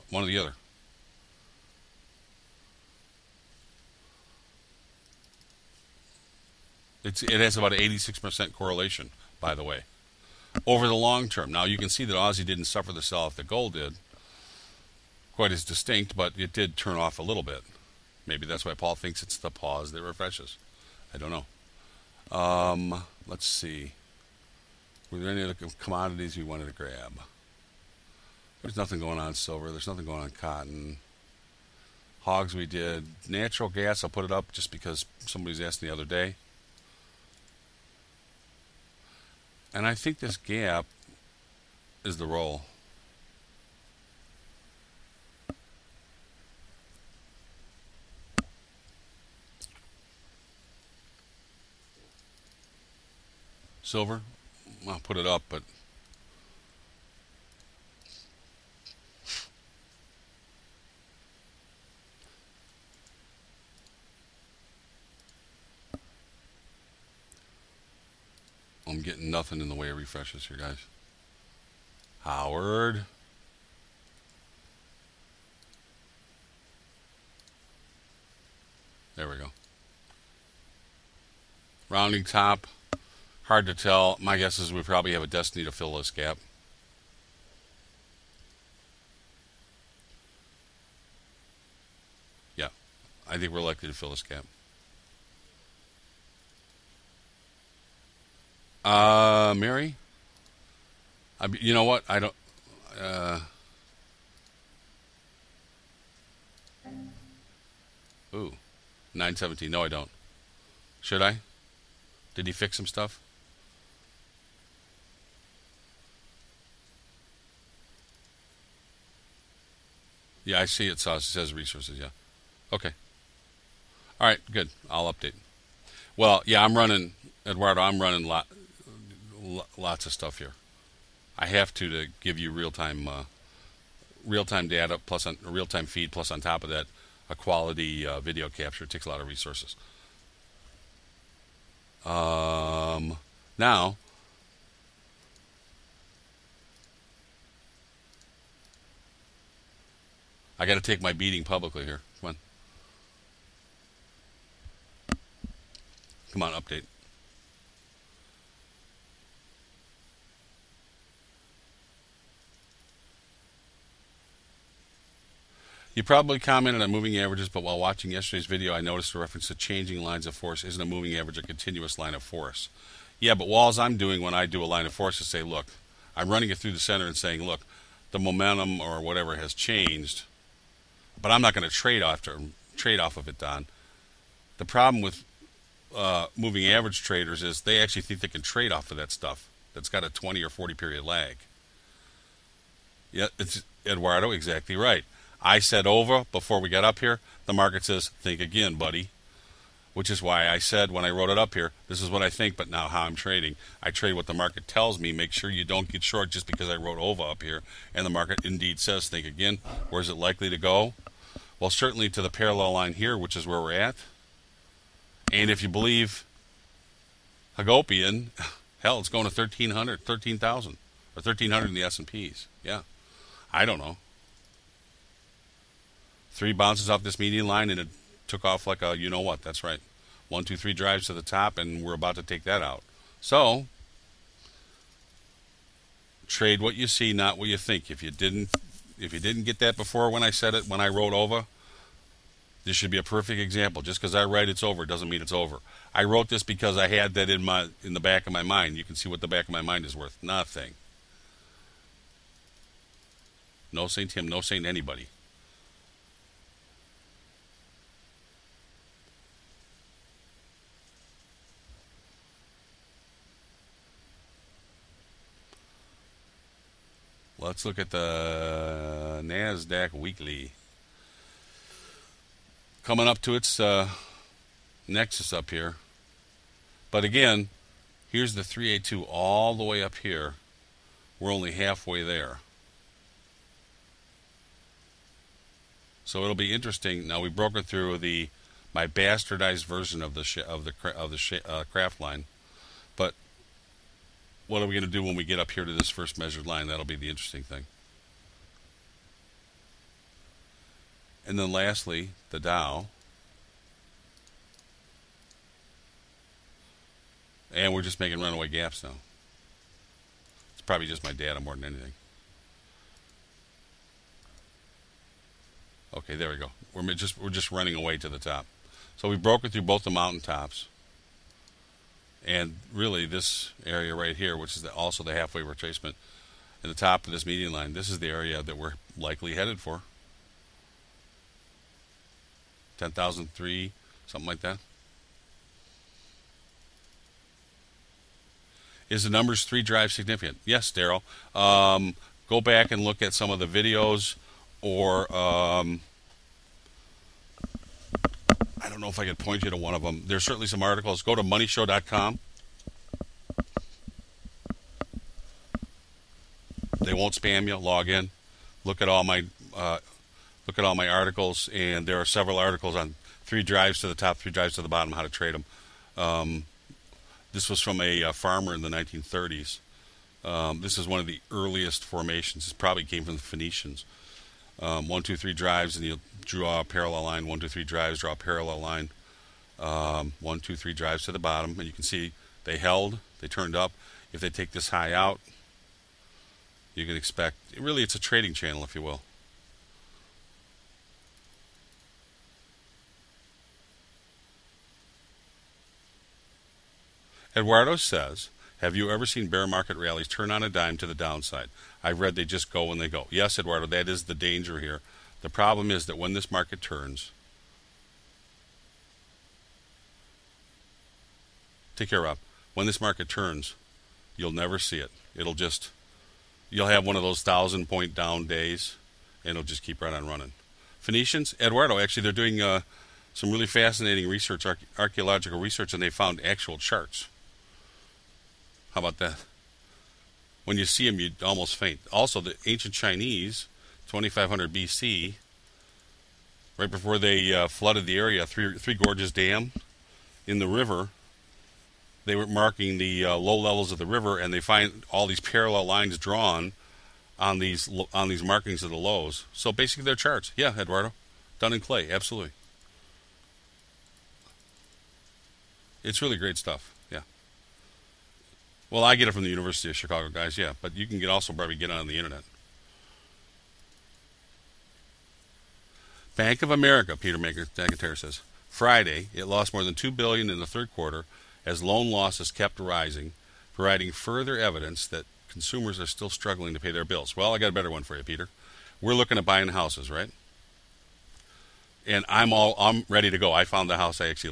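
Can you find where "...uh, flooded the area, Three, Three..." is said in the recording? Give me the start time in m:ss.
7:17.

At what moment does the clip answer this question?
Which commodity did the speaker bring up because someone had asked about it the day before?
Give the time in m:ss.
0:33.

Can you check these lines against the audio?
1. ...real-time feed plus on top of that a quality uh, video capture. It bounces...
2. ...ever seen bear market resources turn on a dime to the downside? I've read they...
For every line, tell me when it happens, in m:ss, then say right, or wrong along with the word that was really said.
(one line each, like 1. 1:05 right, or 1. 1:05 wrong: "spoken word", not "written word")
1. 2:15 wrong: "takes", not "bounces"
2. 6:38 wrong: "rallies", not "resources".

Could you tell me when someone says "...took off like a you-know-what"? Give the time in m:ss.
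3:48.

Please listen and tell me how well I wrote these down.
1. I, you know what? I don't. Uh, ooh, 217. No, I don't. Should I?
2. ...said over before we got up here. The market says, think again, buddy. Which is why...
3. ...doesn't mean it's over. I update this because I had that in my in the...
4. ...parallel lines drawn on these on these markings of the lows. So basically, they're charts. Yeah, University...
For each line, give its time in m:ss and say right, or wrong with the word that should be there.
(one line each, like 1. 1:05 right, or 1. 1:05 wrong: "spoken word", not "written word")
1. 1:41 wrong: "917", not "217"
2. 3:15 right
3. 4:04 wrong: "wrote", not "update"
4. 7:25 wrong: "Eduardo", not "University".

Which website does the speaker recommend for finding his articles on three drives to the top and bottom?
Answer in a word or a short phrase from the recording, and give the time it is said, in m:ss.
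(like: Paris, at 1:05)
moneyshow.com, at 5:51.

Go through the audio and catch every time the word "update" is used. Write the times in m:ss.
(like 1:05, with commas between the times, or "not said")
2:05, 2:36.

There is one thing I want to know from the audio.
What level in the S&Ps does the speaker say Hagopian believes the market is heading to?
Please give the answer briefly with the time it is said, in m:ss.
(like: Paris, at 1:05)
1,300, at 3:41.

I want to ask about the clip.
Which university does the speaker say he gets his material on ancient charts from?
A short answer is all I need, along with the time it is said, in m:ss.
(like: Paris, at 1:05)
University of Chicago, at 7:39.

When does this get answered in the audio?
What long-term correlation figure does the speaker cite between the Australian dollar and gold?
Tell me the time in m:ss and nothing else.
0:07.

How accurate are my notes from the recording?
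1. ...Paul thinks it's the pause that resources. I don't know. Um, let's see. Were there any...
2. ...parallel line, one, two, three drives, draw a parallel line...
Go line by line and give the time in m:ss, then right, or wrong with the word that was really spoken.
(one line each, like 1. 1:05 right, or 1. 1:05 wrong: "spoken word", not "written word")
1. 0:18 wrong: "refreshes", not "resources"
2. 6:16 right.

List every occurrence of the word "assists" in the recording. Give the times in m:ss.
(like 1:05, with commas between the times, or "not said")
not said.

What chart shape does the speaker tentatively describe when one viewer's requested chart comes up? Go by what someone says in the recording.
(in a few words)
Rounding top.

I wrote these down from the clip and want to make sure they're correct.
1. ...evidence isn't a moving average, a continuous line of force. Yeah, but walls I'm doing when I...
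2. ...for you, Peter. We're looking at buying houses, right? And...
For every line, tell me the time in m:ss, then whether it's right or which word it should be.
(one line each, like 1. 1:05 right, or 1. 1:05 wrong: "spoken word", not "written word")
1. 2:50 wrong: "force", not "evidence"
2. 7:57 right.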